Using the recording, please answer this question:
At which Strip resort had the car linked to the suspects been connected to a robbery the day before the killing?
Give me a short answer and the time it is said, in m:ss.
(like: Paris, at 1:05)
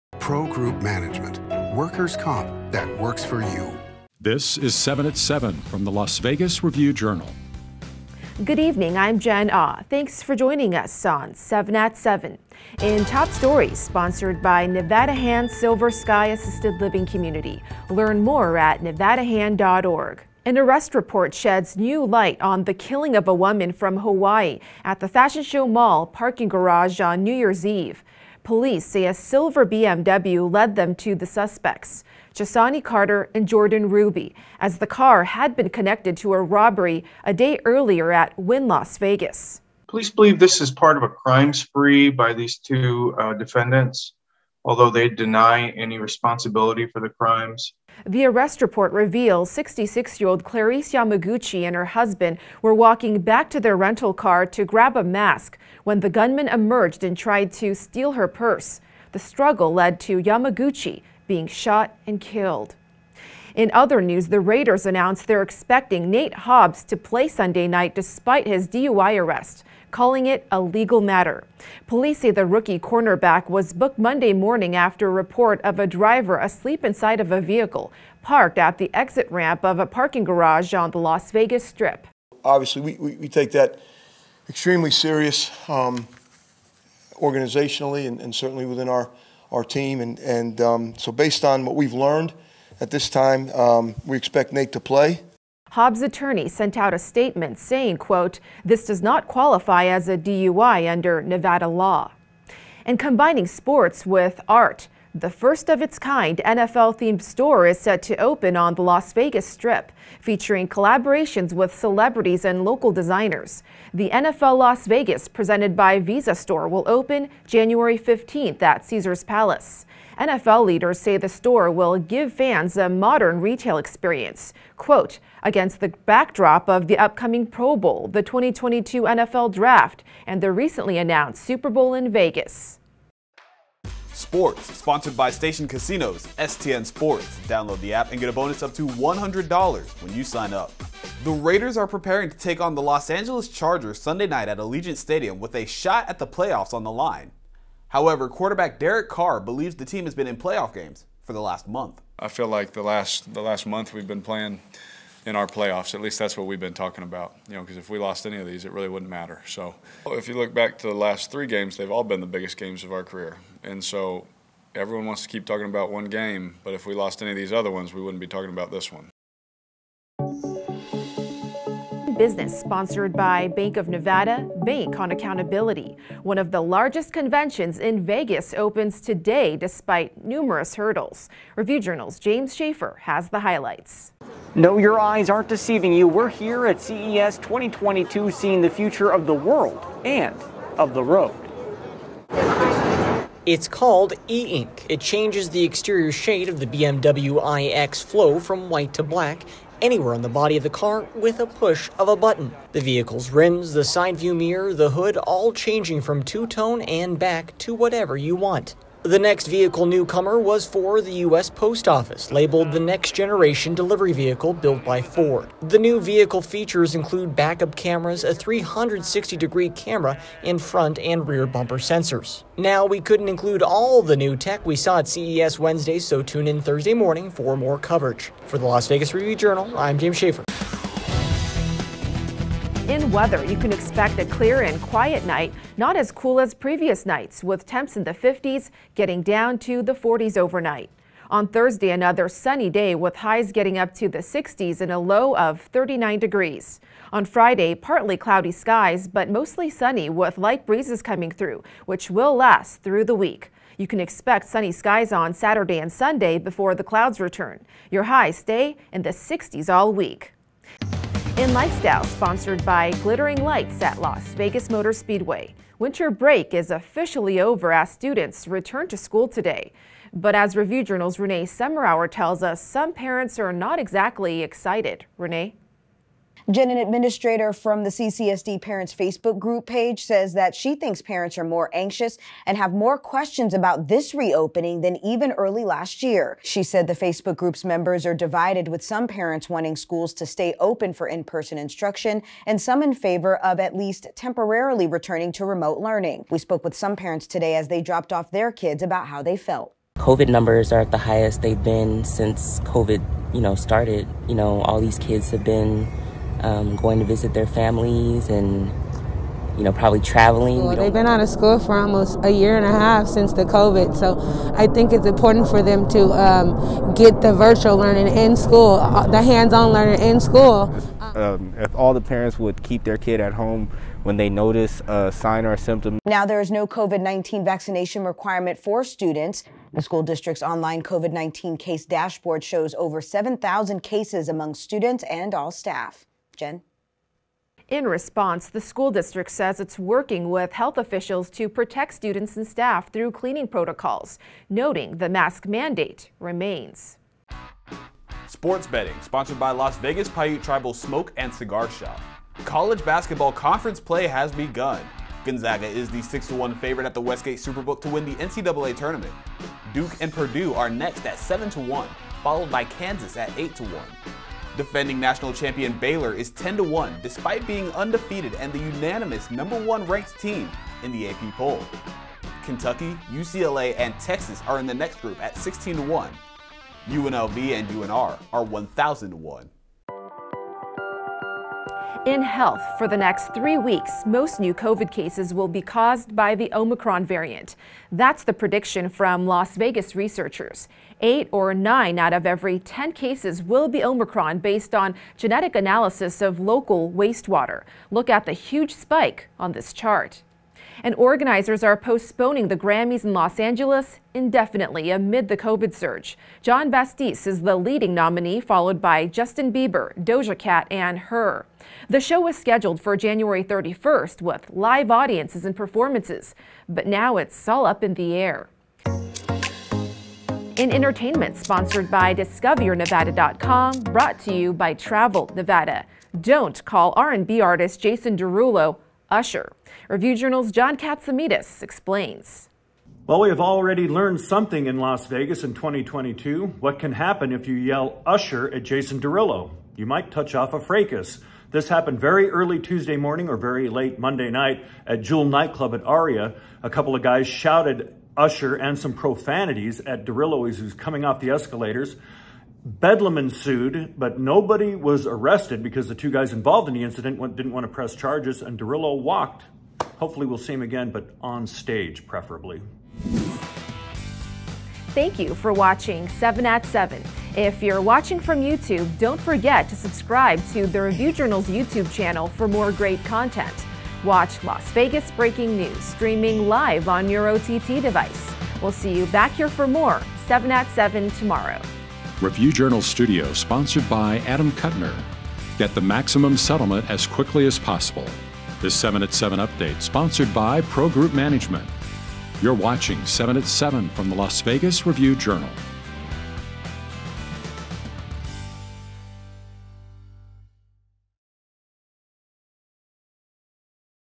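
Wynn Las Vegas, at 0:38.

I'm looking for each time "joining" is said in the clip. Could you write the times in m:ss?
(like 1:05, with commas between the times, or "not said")
0:10.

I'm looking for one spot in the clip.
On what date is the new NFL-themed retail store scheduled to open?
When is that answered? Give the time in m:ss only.
1:57.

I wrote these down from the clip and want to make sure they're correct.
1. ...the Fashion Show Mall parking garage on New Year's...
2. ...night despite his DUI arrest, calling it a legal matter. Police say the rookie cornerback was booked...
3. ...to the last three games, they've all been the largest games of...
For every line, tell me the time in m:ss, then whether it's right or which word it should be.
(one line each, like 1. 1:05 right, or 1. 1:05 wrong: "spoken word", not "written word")
1. 0:24 right
2. 1:07 right
3. 2:40 wrong: "biggest", not "largest".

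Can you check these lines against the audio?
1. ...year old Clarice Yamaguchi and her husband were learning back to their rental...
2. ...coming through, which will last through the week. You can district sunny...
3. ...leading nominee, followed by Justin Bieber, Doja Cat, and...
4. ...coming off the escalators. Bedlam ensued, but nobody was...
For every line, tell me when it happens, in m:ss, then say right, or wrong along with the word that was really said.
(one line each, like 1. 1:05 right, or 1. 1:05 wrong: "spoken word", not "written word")
1. 0:50 wrong: "walking", not "learning"
2. 4:11 wrong: "expect", not "district"
3. 6:47 right
4. 7:30 right.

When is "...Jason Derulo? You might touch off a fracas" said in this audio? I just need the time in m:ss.
7:18.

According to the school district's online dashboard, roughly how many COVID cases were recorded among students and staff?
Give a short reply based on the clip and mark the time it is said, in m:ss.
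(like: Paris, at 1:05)
over 7000, at 5:32.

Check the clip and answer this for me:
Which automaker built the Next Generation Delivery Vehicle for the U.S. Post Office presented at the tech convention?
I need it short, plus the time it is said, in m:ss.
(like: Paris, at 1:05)
Ford, at 3:35.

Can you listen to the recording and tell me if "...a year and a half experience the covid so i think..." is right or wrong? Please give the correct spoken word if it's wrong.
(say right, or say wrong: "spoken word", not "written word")
wrong: "since", not "experience".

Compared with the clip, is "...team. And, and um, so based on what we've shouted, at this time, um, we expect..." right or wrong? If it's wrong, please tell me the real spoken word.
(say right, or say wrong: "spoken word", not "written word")
wrong: "learned", not "shouted".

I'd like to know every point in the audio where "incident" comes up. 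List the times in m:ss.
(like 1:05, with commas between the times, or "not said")
7:36.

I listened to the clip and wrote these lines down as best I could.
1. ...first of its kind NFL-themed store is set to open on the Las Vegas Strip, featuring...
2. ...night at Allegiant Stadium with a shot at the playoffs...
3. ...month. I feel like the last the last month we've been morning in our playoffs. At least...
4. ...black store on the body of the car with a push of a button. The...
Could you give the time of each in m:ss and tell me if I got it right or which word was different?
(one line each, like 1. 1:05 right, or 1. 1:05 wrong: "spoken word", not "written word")
1. 1:45 right
2. 2:24 right
3. 2:31 wrong: "playing", not "morning"
4. 3:19 wrong: "anywhere", not "store".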